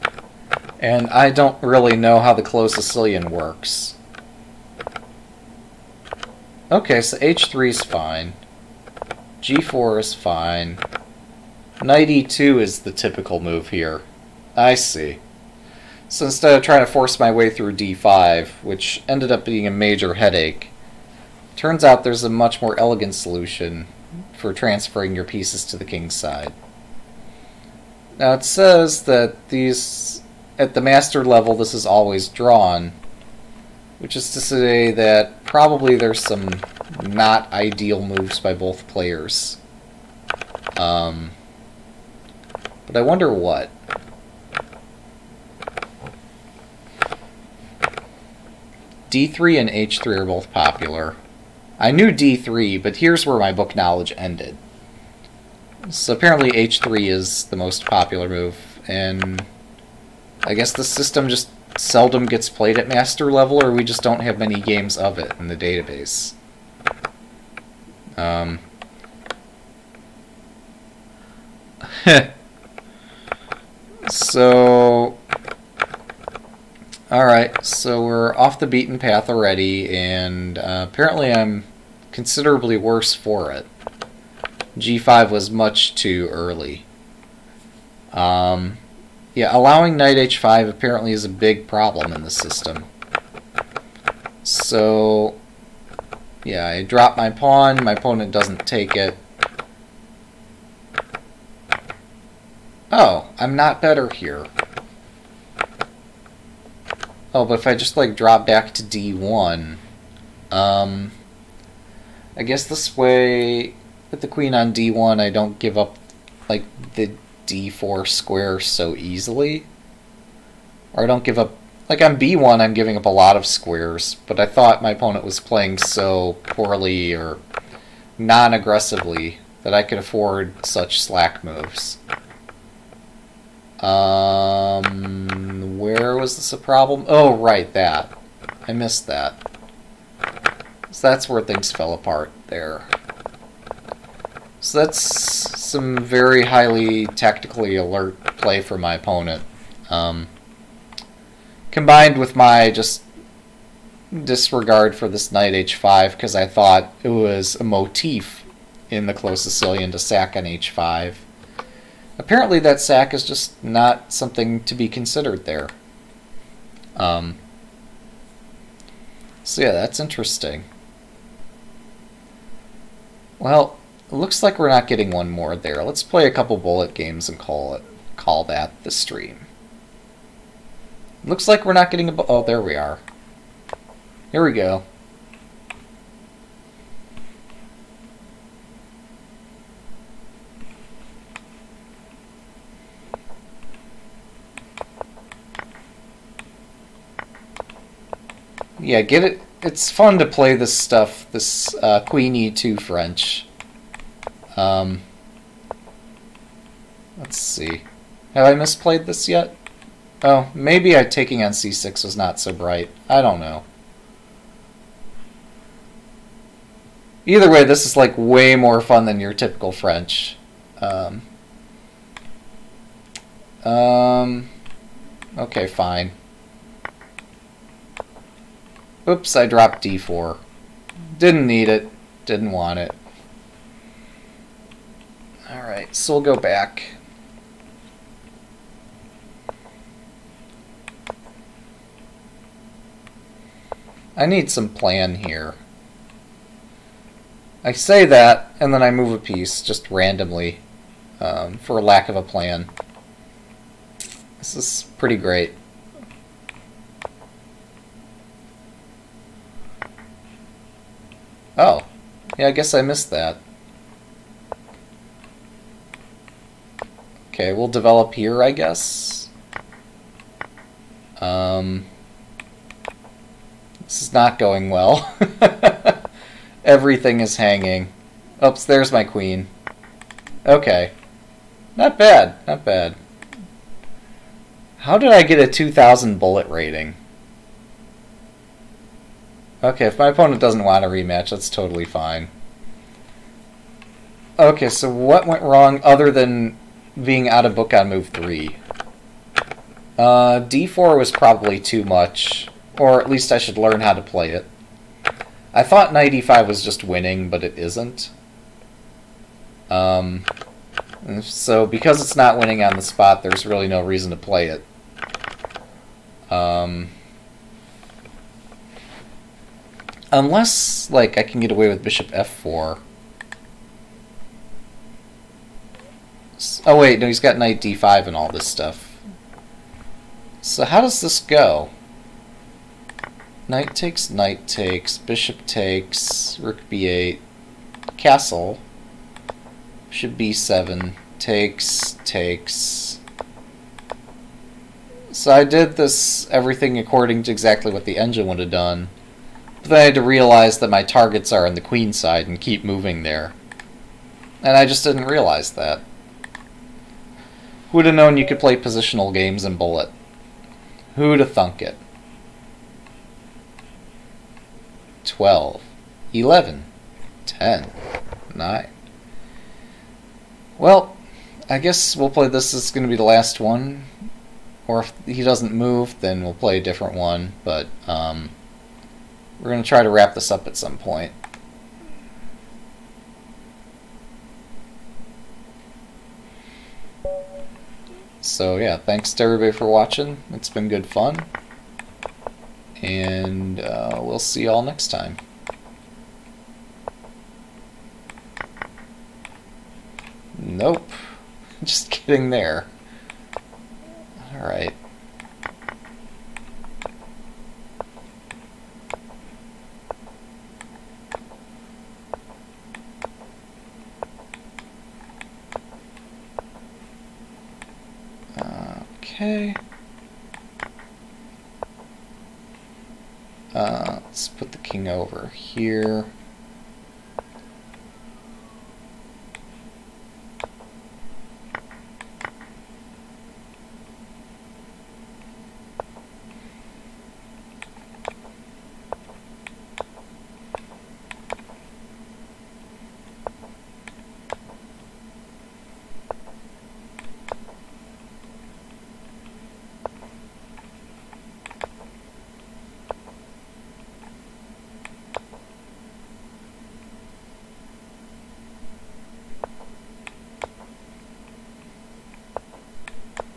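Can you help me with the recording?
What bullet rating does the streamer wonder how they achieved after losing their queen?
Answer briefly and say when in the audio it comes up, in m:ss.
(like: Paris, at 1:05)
2,000, at 4:45.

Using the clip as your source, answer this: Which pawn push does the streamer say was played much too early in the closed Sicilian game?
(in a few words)
G5.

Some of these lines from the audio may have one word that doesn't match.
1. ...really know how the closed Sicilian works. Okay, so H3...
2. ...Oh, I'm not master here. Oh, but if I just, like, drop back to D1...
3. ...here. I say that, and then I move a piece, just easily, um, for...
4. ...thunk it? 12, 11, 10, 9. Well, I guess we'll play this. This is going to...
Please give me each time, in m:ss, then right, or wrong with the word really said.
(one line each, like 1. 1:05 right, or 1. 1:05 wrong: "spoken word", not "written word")
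1. 0:01 right
2. 1:42 wrong: "better", not "master"
3. 4:05 wrong: "randomly", not "easily"
4. 6:01 right.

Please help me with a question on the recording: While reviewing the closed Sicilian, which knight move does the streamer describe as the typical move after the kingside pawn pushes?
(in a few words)
Knight e2.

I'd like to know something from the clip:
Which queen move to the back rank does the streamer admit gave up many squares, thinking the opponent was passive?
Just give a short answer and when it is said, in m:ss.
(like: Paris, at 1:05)
B1, at 2:01.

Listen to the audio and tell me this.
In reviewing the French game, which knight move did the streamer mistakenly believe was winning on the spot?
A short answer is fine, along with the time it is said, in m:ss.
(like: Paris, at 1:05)
Knight e5, at 5:05.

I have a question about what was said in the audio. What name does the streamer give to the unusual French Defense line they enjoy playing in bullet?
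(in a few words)
Queen E2 French.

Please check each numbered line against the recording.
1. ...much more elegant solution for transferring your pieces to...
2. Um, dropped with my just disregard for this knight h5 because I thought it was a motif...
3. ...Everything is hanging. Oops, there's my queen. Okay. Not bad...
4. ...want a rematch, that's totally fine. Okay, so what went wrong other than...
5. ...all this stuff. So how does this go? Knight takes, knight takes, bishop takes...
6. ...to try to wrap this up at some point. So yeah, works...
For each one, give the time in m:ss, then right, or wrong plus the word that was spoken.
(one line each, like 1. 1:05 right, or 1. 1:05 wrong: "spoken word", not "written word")
1. 0:22 right
2. 2:29 wrong: "combined", not "dropped"
3. 4:36 right
4. 4:50 right
5. 5:28 right
6. 6:19 wrong: "thanks", not "works".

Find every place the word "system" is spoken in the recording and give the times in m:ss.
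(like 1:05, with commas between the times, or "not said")
1:00, 1:32.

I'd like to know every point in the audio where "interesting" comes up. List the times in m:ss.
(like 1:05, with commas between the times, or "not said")
2:49.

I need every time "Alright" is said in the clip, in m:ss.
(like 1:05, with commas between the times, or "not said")
3:55, 6:44.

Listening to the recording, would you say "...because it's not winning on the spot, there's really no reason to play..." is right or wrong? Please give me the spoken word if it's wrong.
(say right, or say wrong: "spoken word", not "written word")
right.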